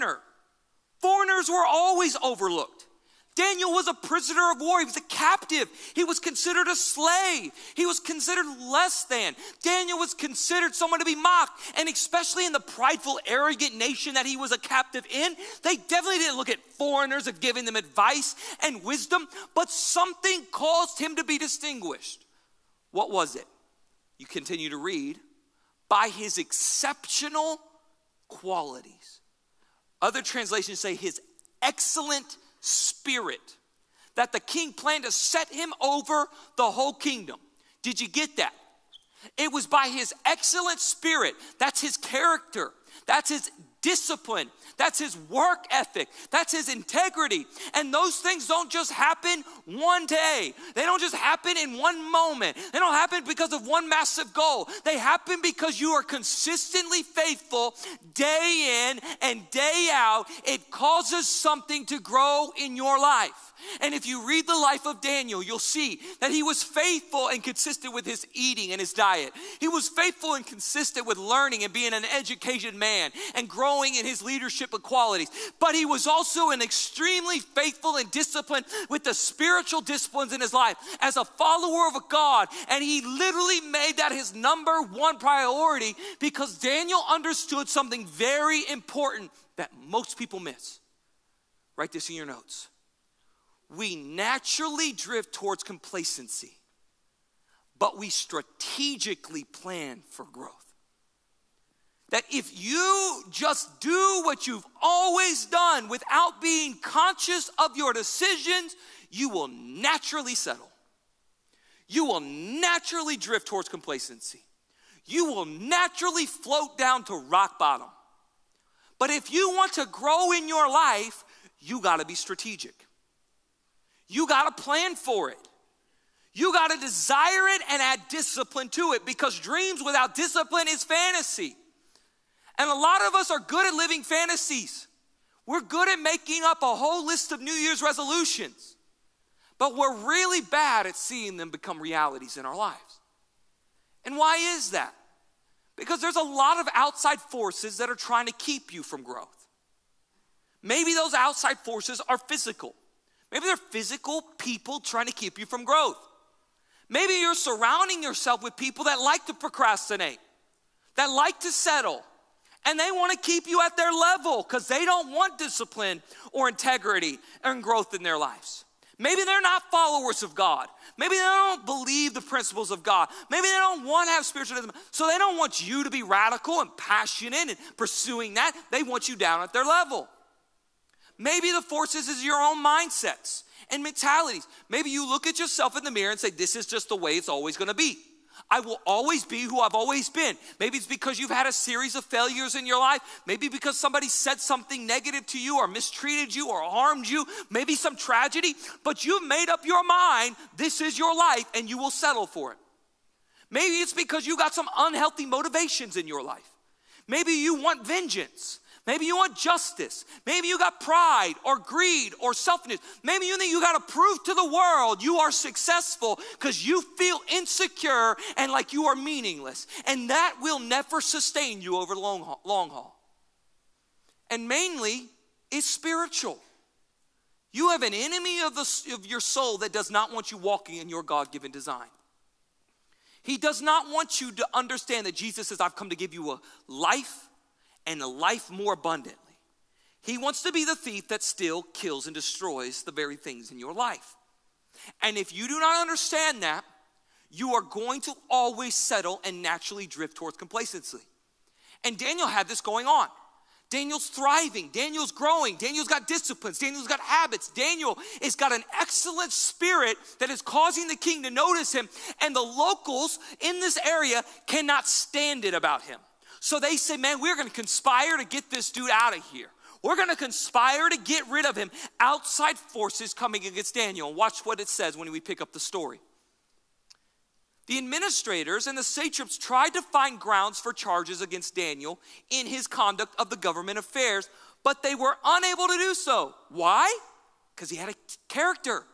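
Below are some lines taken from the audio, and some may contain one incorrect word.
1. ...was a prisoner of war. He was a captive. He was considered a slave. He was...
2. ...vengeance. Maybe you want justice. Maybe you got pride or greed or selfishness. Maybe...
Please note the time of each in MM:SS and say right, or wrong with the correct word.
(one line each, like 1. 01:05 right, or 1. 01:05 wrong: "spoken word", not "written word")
1. 00:03 right
2. 03:27 right.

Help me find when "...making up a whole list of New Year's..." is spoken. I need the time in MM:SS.
02:15.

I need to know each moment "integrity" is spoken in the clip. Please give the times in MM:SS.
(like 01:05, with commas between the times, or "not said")
00:46, 02:46.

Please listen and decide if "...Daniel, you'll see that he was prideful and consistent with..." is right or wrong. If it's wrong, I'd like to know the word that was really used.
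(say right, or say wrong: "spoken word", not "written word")
wrong: "faithful", not "prideful".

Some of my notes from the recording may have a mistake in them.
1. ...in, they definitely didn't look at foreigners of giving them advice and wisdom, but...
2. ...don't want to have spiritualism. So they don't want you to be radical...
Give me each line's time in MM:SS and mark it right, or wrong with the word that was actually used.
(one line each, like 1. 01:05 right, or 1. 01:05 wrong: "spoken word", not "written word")
1. 00:15 right
2. 02:53 right.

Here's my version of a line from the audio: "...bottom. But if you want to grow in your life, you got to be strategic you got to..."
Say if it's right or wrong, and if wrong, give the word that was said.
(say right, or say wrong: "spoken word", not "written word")
right.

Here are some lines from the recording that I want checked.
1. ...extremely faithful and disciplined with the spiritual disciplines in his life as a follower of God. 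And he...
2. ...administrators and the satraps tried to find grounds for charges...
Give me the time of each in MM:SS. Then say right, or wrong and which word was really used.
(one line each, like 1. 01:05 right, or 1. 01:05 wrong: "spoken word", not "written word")
1. 01:16 right
2. 04:37 right.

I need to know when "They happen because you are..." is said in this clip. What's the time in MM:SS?
00:54.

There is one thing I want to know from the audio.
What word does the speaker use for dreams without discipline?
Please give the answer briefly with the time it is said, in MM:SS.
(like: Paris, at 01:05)
fantasy, at 02:10.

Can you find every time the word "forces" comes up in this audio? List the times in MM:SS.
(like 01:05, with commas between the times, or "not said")
02:27, 02:31, 03:01, 04:32.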